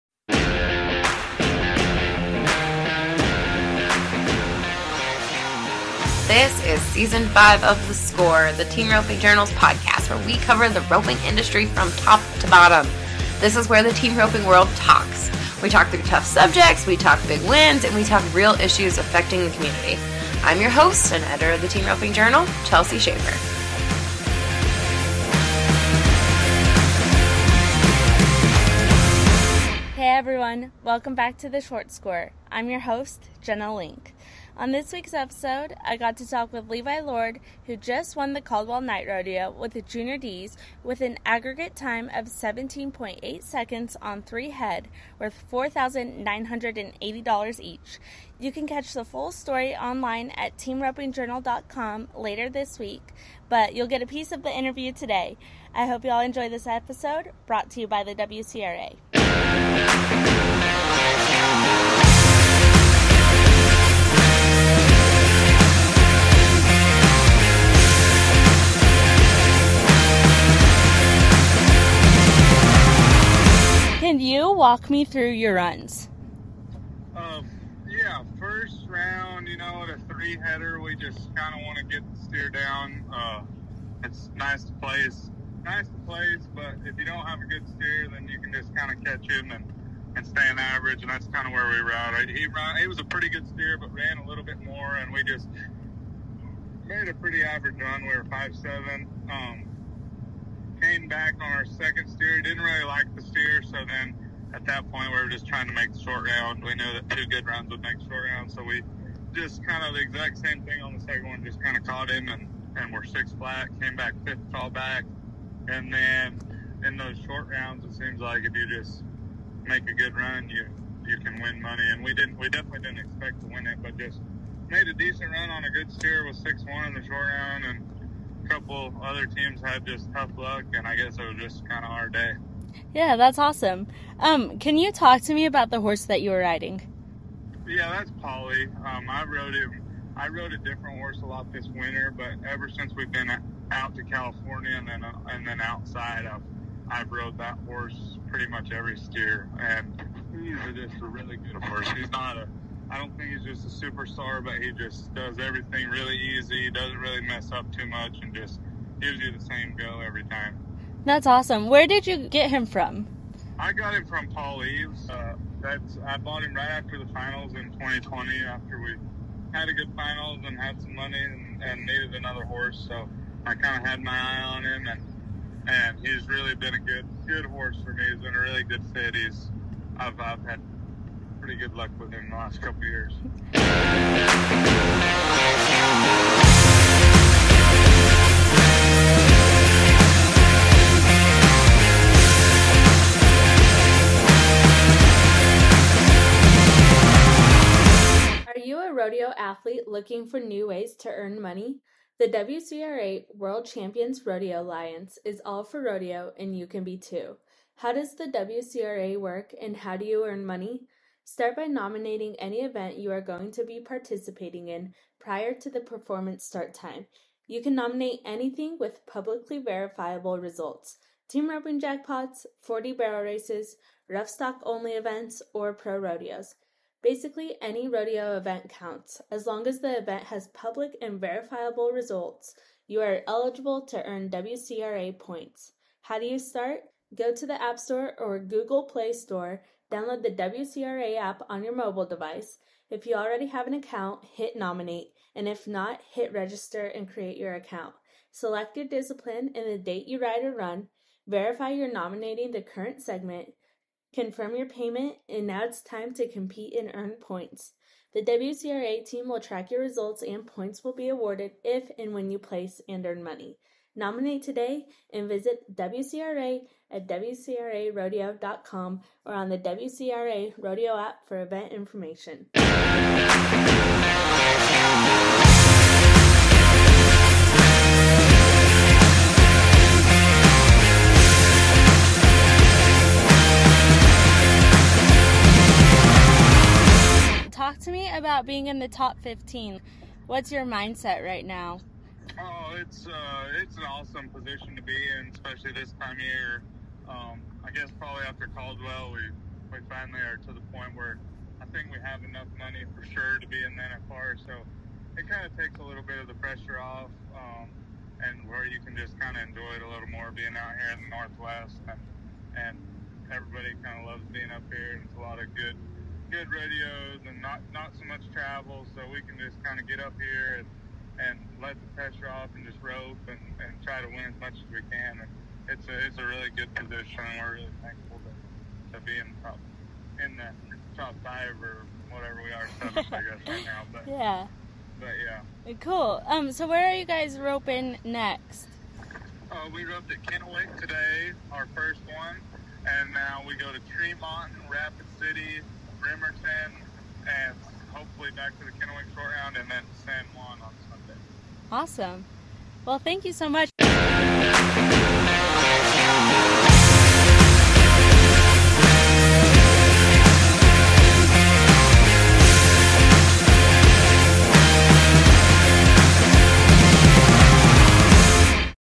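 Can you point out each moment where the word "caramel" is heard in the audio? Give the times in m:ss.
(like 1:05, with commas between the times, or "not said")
not said.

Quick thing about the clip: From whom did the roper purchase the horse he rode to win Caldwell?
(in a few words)
Paul Eaves.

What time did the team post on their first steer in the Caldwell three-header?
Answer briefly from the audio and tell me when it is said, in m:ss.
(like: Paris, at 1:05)
5.7, at 1:38.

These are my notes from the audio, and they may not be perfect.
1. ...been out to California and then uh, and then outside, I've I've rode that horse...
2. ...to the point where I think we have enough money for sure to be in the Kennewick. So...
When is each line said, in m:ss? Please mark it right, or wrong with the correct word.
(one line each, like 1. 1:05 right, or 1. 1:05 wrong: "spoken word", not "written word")
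1. 2:23 right
2. 5:00 wrong: "NFR", not "Kennewick".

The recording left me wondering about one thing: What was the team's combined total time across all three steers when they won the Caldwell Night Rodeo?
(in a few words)
17.8 seconds.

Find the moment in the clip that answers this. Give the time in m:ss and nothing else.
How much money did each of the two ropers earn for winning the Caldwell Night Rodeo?
0:45.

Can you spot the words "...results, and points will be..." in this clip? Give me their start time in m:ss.
4:19.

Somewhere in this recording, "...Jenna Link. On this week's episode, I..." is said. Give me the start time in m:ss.
0:33.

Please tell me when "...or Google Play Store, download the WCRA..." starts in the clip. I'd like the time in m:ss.
3:58.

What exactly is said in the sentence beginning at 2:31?
He's not a I don't think he's just a superstar, but he just does everything really easy.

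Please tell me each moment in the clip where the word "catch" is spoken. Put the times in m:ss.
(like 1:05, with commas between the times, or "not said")
0:48, 1:29.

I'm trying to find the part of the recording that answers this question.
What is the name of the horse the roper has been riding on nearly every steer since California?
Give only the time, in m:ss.
2:18.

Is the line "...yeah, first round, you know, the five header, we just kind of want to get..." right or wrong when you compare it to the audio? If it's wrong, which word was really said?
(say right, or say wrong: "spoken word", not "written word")
wrong: "three", not "five".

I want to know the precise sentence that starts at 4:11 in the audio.
Verify you're nominating the current segment.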